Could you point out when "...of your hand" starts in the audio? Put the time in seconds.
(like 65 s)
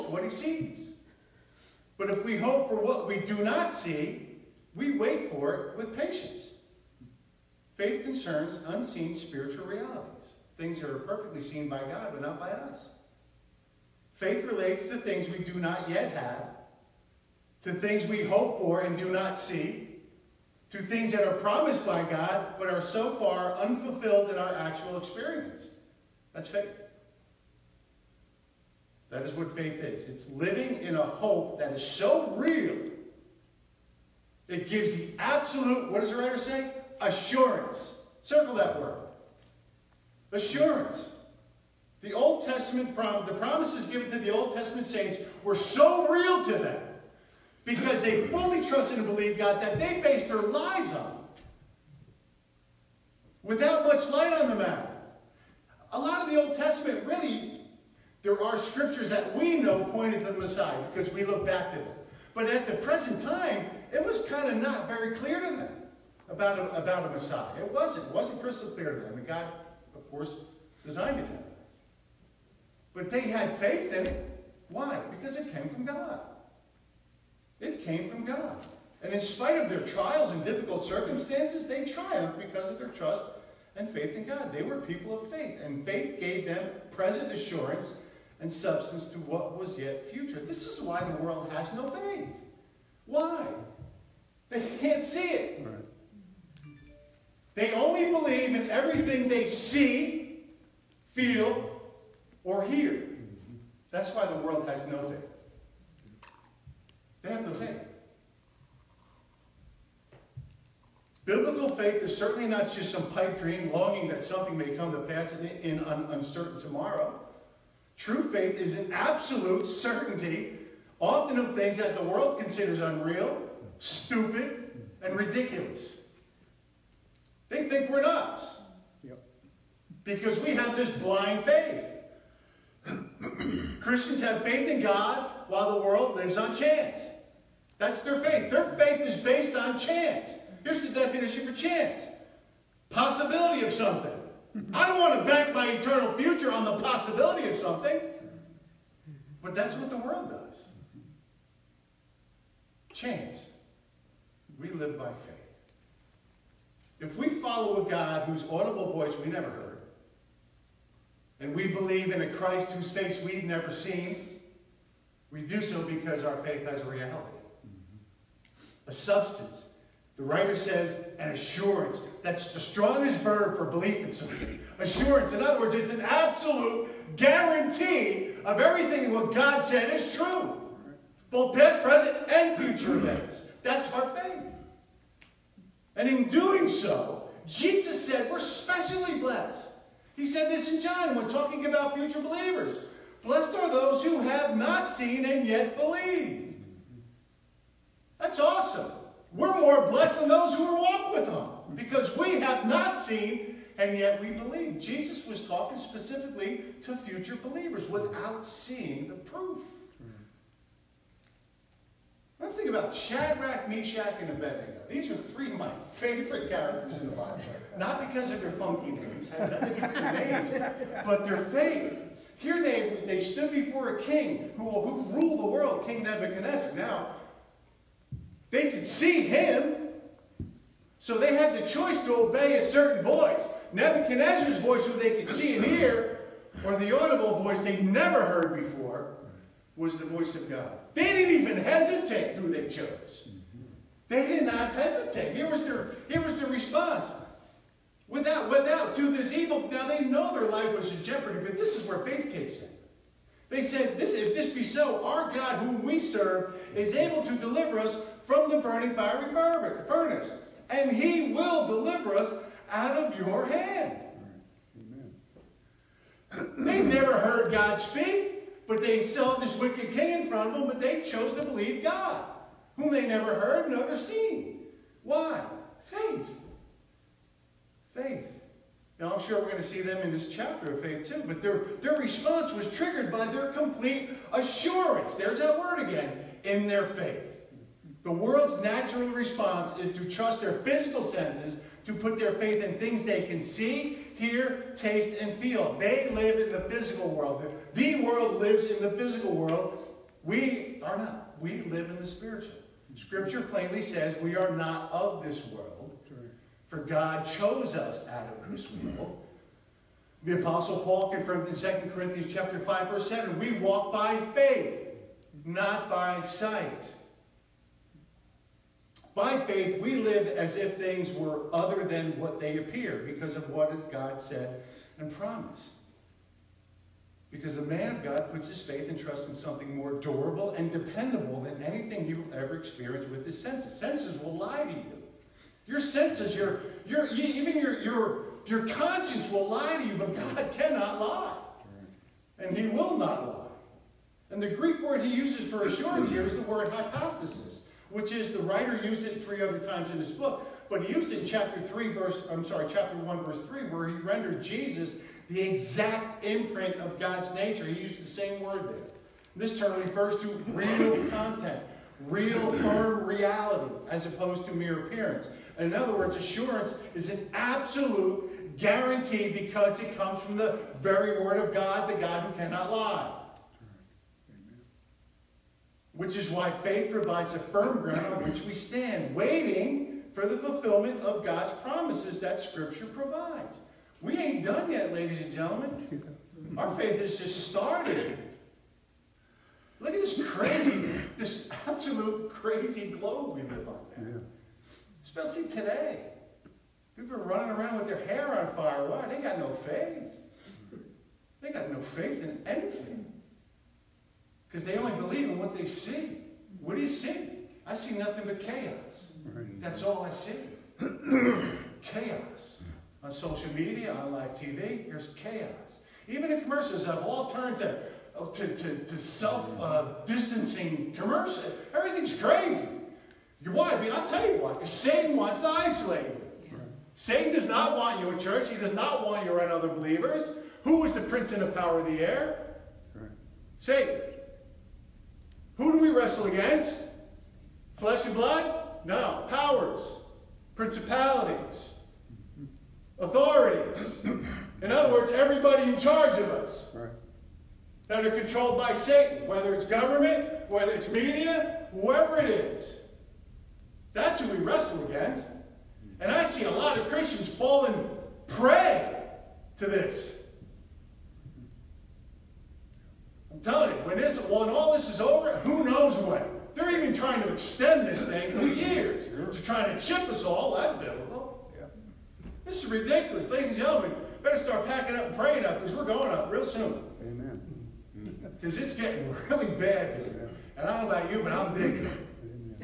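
262 s.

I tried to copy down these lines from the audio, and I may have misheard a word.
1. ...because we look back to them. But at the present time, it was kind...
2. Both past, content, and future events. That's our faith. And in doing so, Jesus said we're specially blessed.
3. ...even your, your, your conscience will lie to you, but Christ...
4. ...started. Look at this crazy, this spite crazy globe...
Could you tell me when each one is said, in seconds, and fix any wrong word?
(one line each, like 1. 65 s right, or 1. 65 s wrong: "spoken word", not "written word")
1. 60 s right
2. 181 s wrong: "present", not "content"
3. 337 s wrong: "God", not "Christ"
4. 387 s wrong: "absolute", not "spite".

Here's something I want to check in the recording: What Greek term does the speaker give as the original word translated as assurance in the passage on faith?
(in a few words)
hypostasis.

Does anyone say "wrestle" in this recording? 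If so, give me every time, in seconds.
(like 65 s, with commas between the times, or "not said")
435 s, 454 s.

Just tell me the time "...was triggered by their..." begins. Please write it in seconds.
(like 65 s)
282 s.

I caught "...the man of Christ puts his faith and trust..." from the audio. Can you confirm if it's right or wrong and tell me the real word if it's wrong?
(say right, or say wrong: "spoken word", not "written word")
wrong: "God", not "Christ".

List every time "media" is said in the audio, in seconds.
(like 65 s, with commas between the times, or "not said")
413 s, 450 s.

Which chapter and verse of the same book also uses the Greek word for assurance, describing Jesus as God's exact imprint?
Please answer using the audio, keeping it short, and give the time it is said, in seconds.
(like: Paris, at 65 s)
Chapter 1, verse 3, at 352 s.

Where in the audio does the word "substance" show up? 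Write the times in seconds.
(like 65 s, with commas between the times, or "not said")
88 s, 168 s.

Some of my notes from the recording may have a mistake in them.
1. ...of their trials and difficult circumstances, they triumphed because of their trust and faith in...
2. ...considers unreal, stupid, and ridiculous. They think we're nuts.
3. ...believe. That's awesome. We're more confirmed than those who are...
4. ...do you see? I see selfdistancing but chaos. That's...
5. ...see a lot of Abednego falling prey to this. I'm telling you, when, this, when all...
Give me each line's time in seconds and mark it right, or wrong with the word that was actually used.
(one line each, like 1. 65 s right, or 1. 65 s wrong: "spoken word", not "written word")
1. 79 s right
2. 122 s right
3. 195 s wrong: "blessed", not "confirmed"
4. 406 s wrong: "nothing", not "selfdistancing"
5. 456 s wrong: "Christians", not "Abednego".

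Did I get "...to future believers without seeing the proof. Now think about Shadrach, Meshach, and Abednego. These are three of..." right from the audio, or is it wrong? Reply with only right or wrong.
right.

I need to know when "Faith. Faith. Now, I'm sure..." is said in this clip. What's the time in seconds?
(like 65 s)
275 s.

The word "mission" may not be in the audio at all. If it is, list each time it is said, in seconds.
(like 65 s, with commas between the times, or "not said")
not said.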